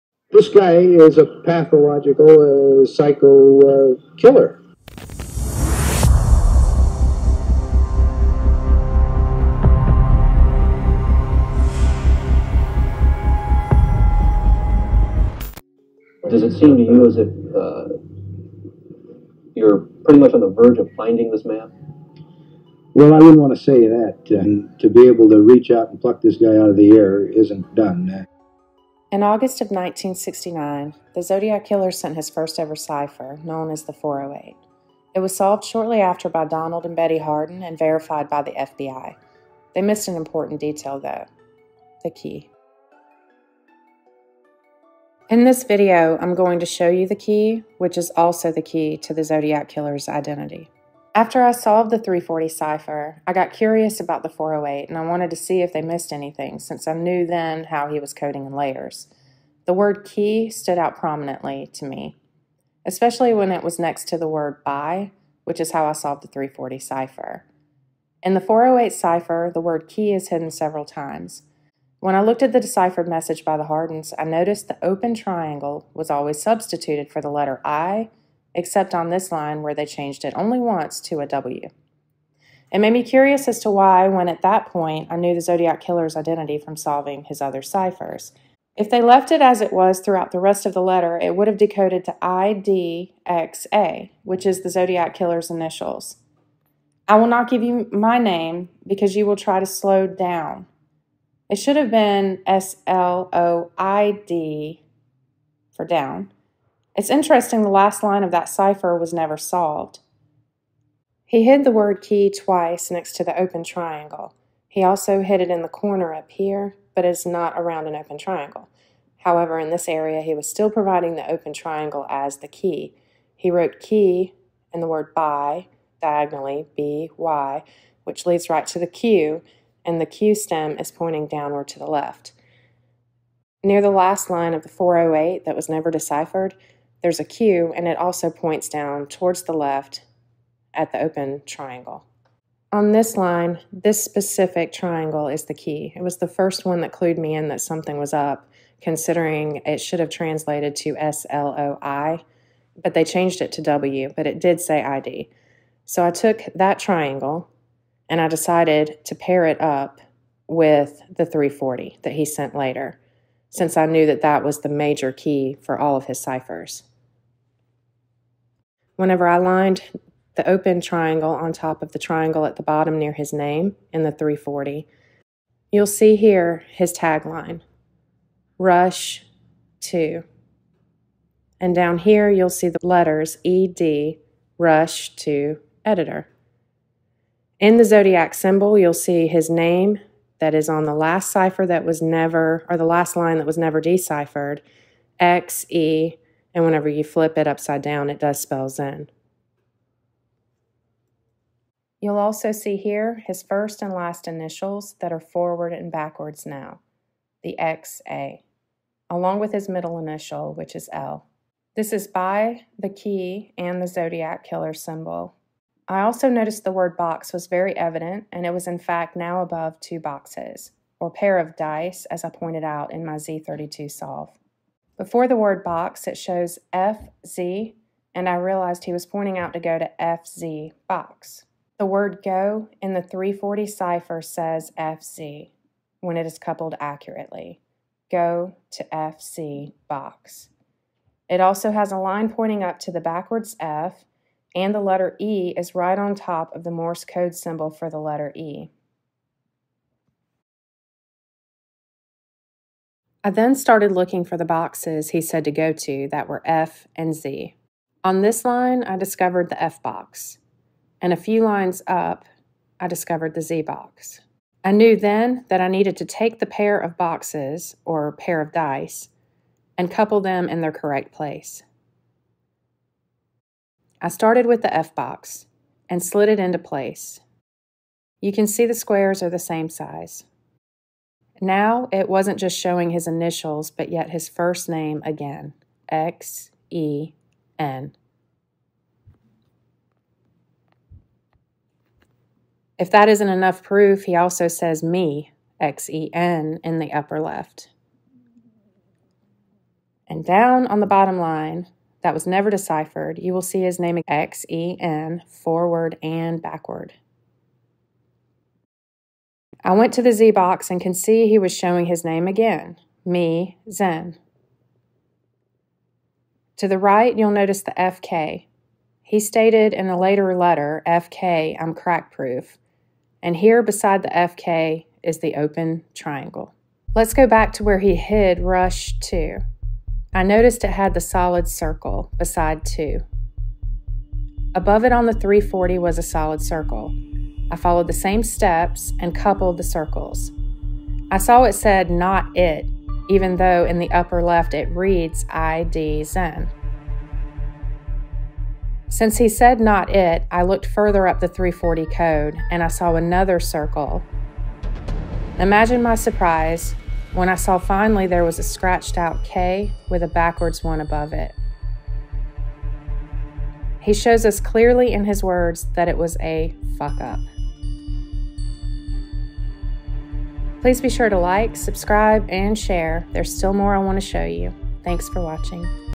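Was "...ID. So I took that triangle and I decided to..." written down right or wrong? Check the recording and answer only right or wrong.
right.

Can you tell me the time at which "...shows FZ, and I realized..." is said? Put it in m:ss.
3:46.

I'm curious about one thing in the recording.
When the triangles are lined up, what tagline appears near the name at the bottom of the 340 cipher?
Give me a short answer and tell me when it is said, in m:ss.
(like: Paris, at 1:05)
Rush 2 Editor, at 3:04.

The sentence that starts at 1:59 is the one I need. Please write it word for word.
However, in this area, he was still providing the open triangle as the key.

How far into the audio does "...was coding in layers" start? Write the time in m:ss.
0:57.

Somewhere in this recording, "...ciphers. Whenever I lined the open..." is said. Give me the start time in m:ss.
2:46.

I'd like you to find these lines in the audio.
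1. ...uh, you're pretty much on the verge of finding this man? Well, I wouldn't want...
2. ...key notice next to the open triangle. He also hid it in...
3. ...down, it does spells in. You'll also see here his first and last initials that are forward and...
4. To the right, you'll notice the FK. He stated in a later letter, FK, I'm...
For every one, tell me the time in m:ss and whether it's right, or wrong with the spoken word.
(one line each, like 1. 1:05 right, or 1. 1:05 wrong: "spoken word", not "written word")
1. 0:17 right
2. 1:52 wrong: "twice", not "notice"
3. 3:17 right
4. 5:16 right.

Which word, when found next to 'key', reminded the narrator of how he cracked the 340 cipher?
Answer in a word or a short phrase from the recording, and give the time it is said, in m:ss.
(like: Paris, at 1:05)
buy, at 1:04.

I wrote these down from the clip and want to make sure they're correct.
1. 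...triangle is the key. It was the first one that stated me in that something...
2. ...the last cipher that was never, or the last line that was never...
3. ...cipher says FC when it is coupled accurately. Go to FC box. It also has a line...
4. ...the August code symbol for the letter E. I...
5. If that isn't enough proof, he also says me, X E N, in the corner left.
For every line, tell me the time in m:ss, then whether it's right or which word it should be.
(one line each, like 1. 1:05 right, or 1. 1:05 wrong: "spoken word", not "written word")
1. 2:24 wrong: "clued", not "stated"
2. 3:10 right
3. 3:53 right
4. 4:06 wrong: "Morse", not "August"
5. 4:52 wrong: "upper", not "corner".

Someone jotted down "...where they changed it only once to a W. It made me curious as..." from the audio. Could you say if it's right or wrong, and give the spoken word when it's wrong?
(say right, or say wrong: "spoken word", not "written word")
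right.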